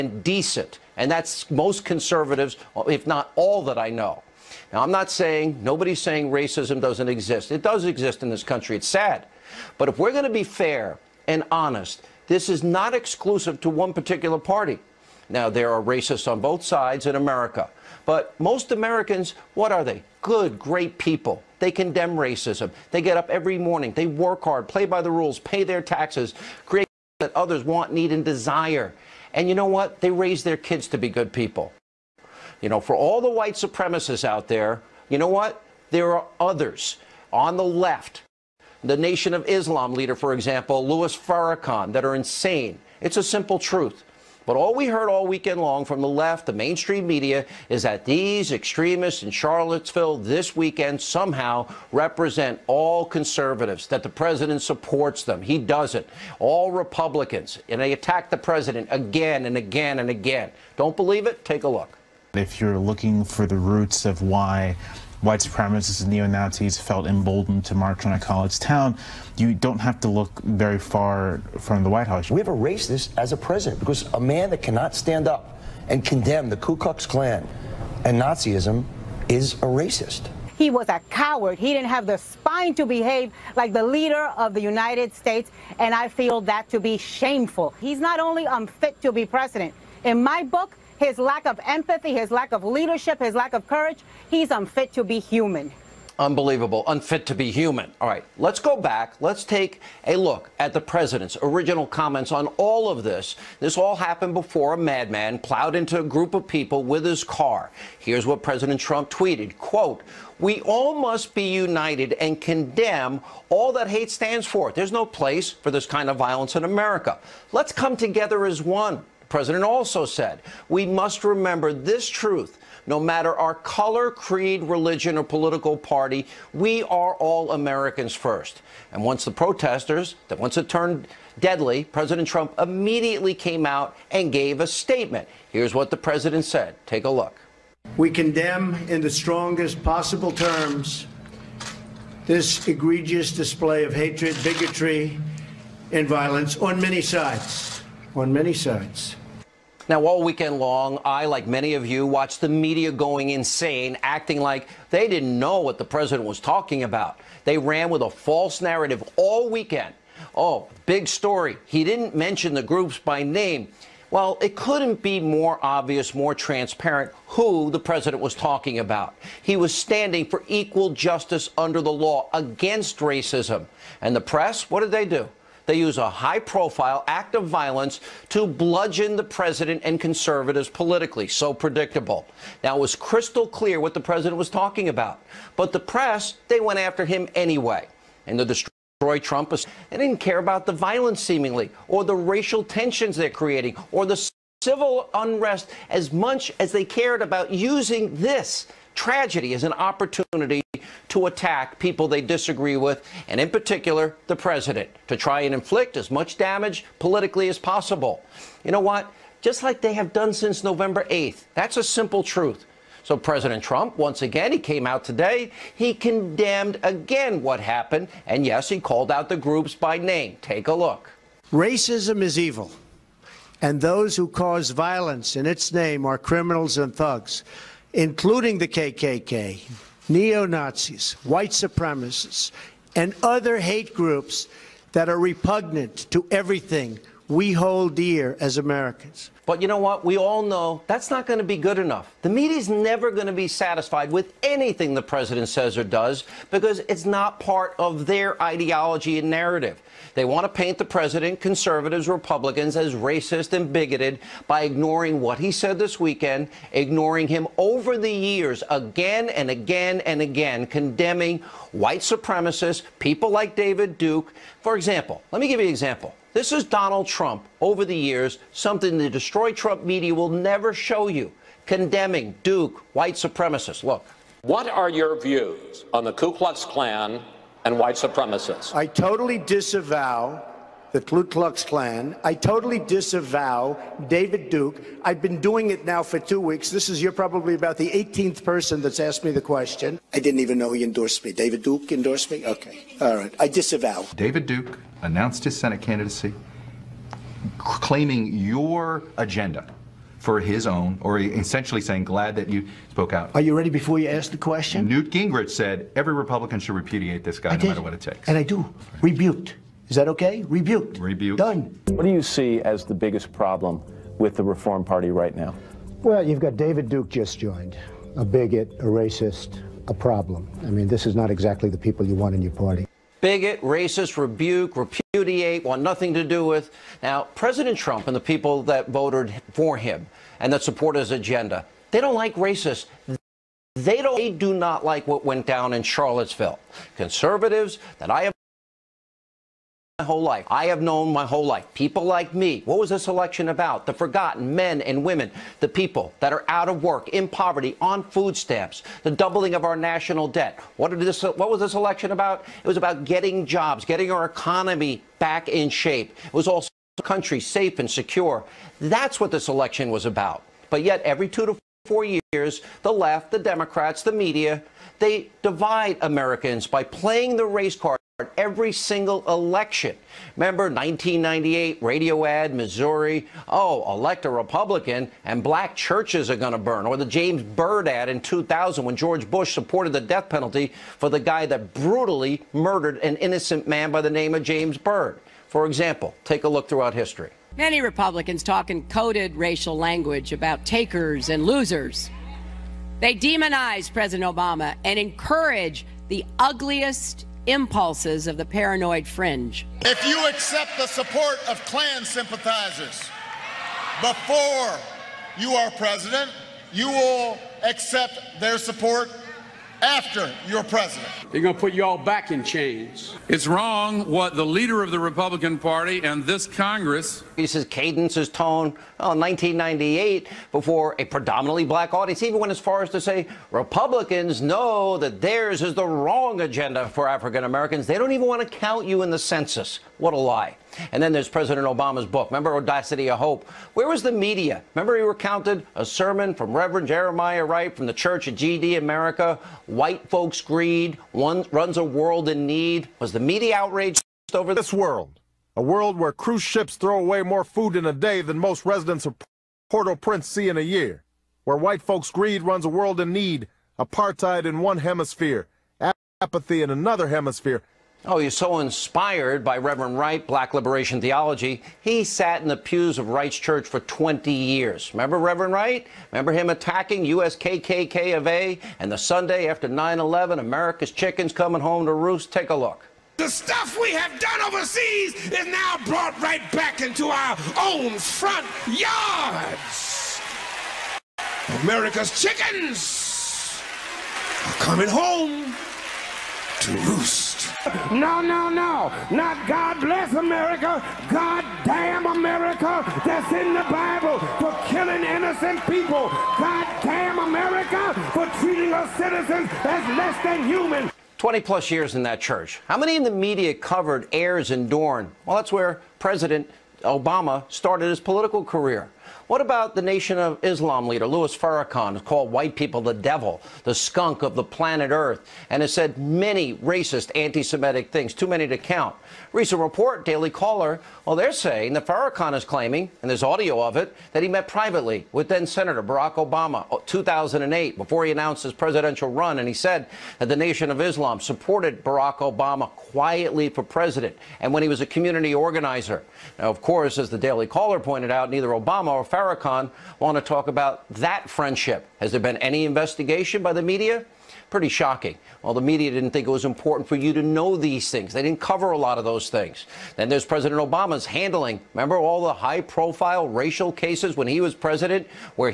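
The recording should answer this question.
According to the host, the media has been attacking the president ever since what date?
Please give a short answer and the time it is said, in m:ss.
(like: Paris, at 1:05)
November 8th, at 3:30.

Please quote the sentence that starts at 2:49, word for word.
He was standing for equal justice under the law against racism.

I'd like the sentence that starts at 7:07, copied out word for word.
They don't even want to count you in the census.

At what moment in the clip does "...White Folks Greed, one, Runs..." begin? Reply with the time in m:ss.
7:19.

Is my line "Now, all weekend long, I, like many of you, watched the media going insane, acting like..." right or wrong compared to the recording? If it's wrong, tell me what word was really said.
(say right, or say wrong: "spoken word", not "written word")
right.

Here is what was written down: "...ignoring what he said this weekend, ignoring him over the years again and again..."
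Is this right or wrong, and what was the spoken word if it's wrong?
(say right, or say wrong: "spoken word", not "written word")
right.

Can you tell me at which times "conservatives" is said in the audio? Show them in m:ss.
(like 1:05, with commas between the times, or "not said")
0:01, 0:53, 2:59, 4:11, 5:36.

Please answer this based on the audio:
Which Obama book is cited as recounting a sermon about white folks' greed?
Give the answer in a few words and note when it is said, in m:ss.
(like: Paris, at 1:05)
Audacity of Hope, at 7:12.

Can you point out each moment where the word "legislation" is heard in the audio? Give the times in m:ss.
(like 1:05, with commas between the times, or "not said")
not said.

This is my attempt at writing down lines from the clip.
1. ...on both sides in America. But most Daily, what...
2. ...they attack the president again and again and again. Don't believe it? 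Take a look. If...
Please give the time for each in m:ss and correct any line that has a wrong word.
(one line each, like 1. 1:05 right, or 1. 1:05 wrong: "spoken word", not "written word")
1. 0:16 wrong: "Americans", not "Daily"
2. 0:57 right.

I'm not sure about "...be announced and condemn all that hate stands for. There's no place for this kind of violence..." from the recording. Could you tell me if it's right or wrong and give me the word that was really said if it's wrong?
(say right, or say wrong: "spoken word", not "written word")
wrong: "united", not "announced".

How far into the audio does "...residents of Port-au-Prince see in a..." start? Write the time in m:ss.
7:28.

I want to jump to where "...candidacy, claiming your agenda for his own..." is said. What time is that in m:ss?
4:55.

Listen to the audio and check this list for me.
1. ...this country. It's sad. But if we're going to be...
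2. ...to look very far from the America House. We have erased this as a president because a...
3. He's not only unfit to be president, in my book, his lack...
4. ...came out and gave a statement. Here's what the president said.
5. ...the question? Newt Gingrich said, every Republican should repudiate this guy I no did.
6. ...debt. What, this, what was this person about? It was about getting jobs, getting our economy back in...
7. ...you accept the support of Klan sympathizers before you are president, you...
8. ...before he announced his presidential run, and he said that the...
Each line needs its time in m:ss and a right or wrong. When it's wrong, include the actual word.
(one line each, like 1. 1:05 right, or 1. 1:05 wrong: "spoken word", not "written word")
1. 0:08 right
2. 1:09 wrong: "White", not "America"
3. 1:27 right
4. 2:13 right
5. 5:04 right
6. 5:50 wrong: "election", not "person"
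7. 6:40 right
8. 8:47 right.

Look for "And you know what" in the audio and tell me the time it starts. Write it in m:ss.
0:29.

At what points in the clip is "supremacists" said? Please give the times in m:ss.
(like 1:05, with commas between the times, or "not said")
0:33, 1:05, 3:51, 4:21, 4:33, 4:37.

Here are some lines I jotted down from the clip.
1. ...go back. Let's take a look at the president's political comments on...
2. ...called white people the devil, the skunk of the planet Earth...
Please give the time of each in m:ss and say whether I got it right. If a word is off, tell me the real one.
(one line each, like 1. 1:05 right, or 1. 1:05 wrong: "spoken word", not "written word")
1. 1:38 wrong: "original", not "political"
2. 8:31 right.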